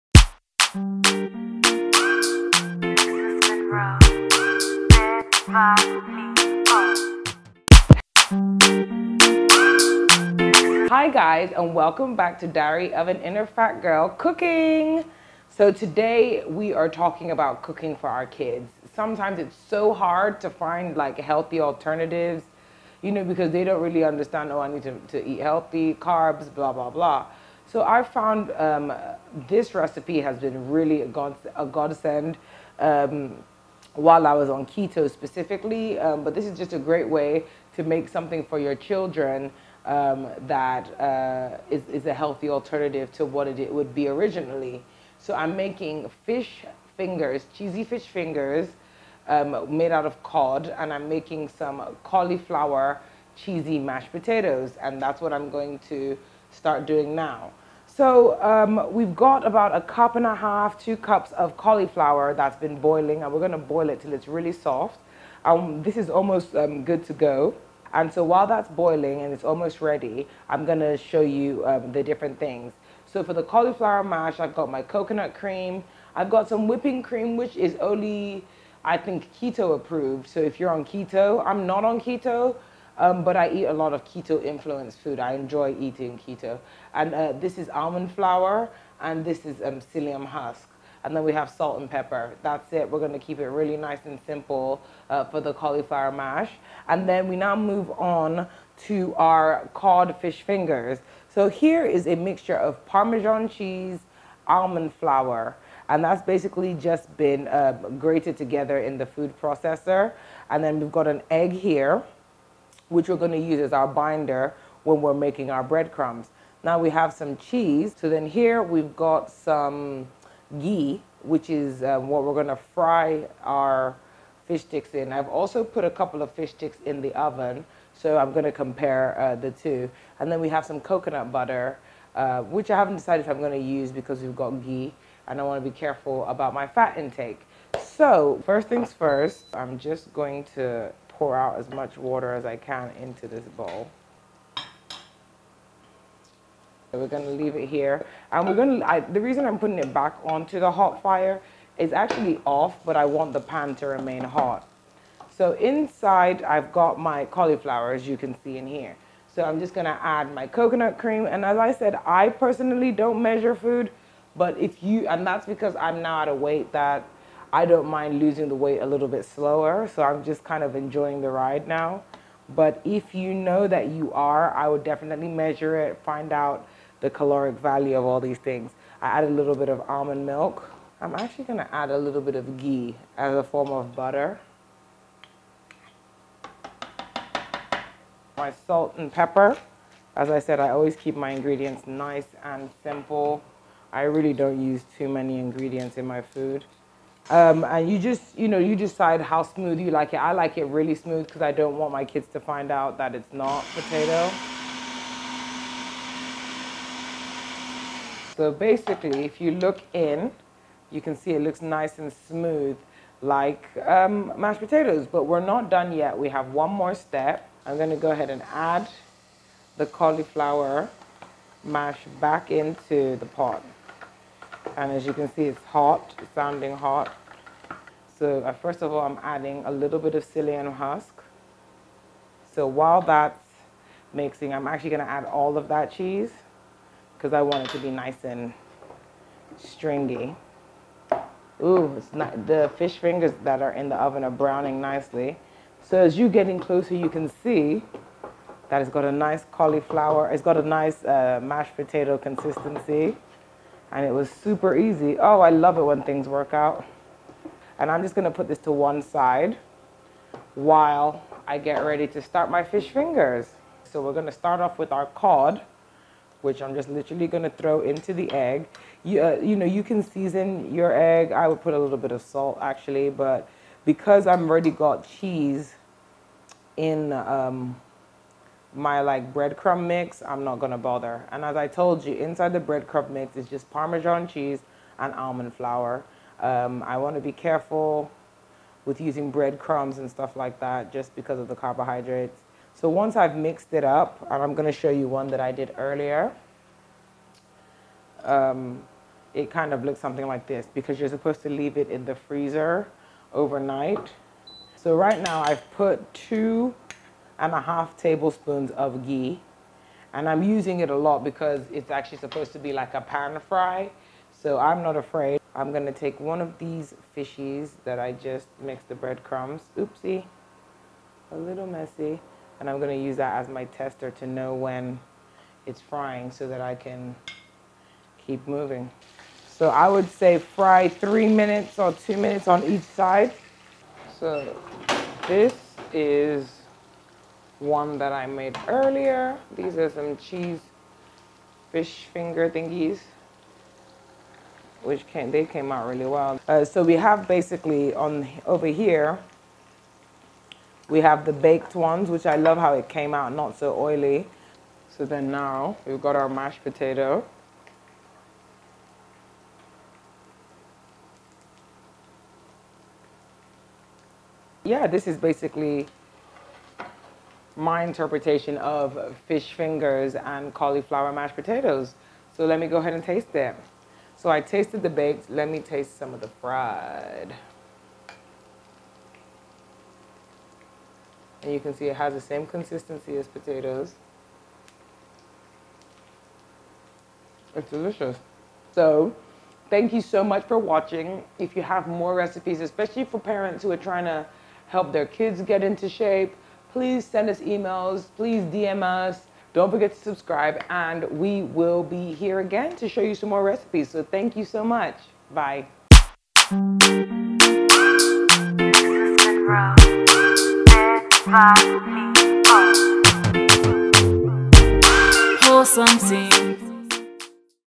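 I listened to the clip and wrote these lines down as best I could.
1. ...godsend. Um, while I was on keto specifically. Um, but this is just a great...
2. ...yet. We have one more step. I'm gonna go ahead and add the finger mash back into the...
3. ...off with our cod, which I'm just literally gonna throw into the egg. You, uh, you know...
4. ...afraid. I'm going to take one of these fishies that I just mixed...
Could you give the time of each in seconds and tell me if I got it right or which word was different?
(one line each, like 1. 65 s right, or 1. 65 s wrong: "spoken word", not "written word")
1. 31 s right
2. 215 s wrong: "cauliflower", not "finger"
3. 264 s right
4. 314 s right.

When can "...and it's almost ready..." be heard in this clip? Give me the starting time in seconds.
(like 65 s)
69 s.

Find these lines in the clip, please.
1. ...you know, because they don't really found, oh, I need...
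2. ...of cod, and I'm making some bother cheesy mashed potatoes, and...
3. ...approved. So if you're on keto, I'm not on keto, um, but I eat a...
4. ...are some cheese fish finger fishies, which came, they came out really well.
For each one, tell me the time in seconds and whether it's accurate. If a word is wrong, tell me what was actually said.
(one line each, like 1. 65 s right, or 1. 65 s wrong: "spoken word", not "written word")
1. 23 s wrong: "understand", not "found"
2. 50 s wrong: "cauliflower", not "bother"
3. 79 s right
4. 339 s wrong: "thingies", not "fishies".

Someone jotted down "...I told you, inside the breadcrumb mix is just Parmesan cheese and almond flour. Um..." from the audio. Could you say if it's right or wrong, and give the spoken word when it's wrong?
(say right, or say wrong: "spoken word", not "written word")
right.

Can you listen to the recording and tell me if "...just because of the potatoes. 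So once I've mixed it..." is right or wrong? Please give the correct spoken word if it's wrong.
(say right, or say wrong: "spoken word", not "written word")
wrong: "carbohydrates", not "potatoes".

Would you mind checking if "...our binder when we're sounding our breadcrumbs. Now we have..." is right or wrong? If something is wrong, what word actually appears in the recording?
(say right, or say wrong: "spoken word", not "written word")
wrong: "making", not "sounding".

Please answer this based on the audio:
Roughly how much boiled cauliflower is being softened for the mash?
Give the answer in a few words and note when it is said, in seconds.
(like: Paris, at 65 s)
1.5 to 2 cups, at 59 s.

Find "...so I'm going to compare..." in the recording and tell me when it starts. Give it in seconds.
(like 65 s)
127 s.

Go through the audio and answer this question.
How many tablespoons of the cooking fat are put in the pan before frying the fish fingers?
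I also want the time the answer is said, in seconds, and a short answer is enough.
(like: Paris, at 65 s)
2.5, at 306 s.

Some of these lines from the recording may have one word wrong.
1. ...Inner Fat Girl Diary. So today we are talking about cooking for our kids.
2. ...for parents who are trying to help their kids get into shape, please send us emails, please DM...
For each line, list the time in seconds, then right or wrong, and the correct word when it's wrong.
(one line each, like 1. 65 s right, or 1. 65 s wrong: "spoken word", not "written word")
1. 13 s wrong: "Cooking", not "Diary"
2. 393 s right.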